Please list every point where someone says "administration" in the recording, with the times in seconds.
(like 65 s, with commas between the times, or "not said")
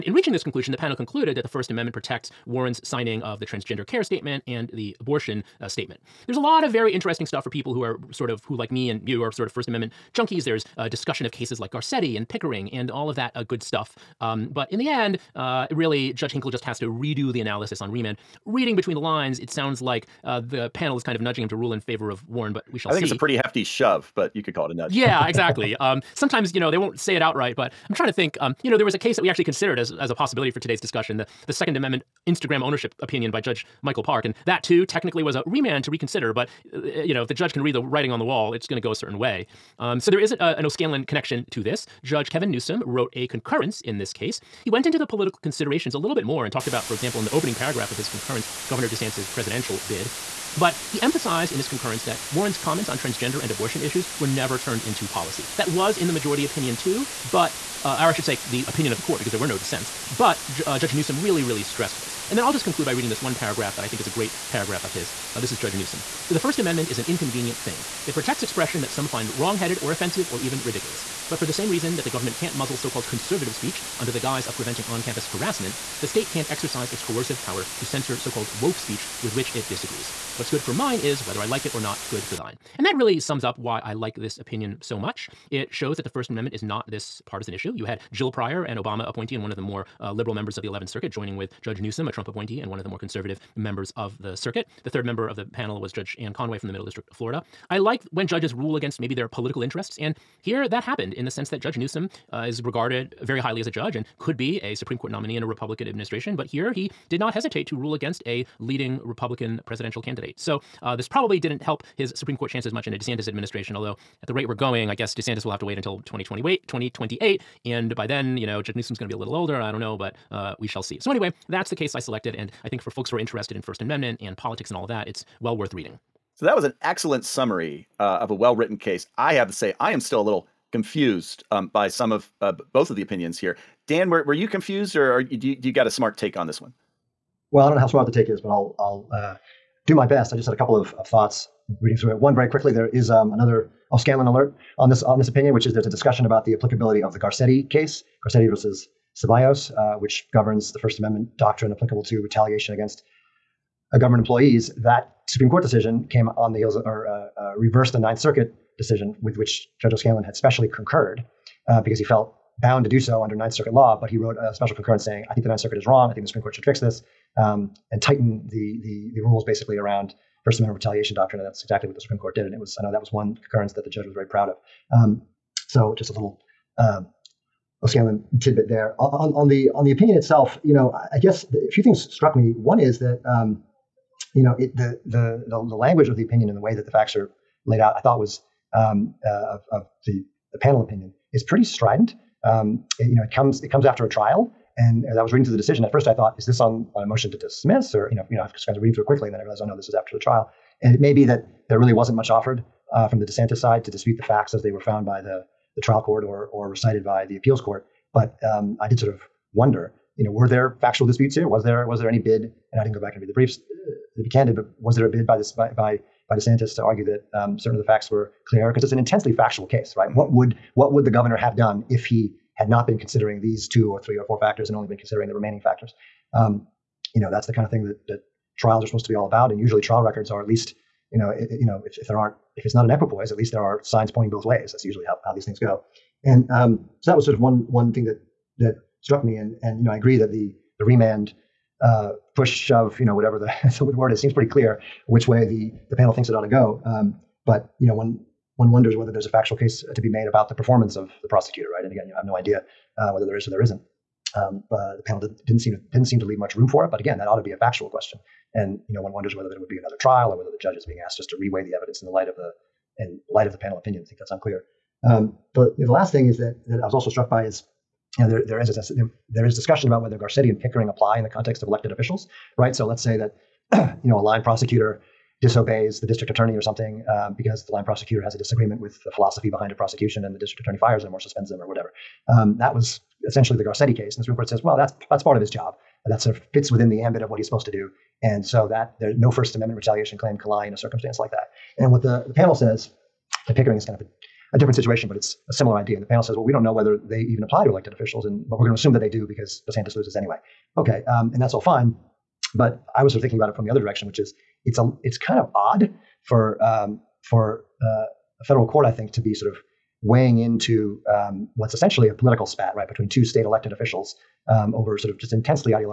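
105 s, 113 s.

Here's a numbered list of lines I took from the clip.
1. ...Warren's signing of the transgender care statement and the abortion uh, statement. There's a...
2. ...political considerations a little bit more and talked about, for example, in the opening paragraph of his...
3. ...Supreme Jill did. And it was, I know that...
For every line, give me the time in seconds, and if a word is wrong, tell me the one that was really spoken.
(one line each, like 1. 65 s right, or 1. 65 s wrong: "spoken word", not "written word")
1. 2 s right
2. 45 s right
3. 172 s wrong: "Court", not "Jill".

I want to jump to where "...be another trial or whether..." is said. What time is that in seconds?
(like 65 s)
259 s.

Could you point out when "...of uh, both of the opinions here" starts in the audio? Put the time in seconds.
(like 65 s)
132 s.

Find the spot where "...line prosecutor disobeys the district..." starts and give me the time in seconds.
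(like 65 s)
274 s.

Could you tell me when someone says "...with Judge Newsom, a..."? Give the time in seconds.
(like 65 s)
91 s.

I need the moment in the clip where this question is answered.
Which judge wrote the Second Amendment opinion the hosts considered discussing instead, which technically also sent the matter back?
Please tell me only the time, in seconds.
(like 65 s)
33 s.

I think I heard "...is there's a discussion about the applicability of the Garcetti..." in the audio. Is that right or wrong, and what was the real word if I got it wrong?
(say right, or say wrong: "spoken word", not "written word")
right.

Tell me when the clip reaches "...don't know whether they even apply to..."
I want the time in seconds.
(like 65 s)
296 s.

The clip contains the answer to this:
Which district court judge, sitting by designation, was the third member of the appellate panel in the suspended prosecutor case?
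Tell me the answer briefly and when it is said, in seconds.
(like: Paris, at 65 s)
Anne Conway, at 95 s.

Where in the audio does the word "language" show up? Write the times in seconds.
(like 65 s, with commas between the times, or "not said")
185 s.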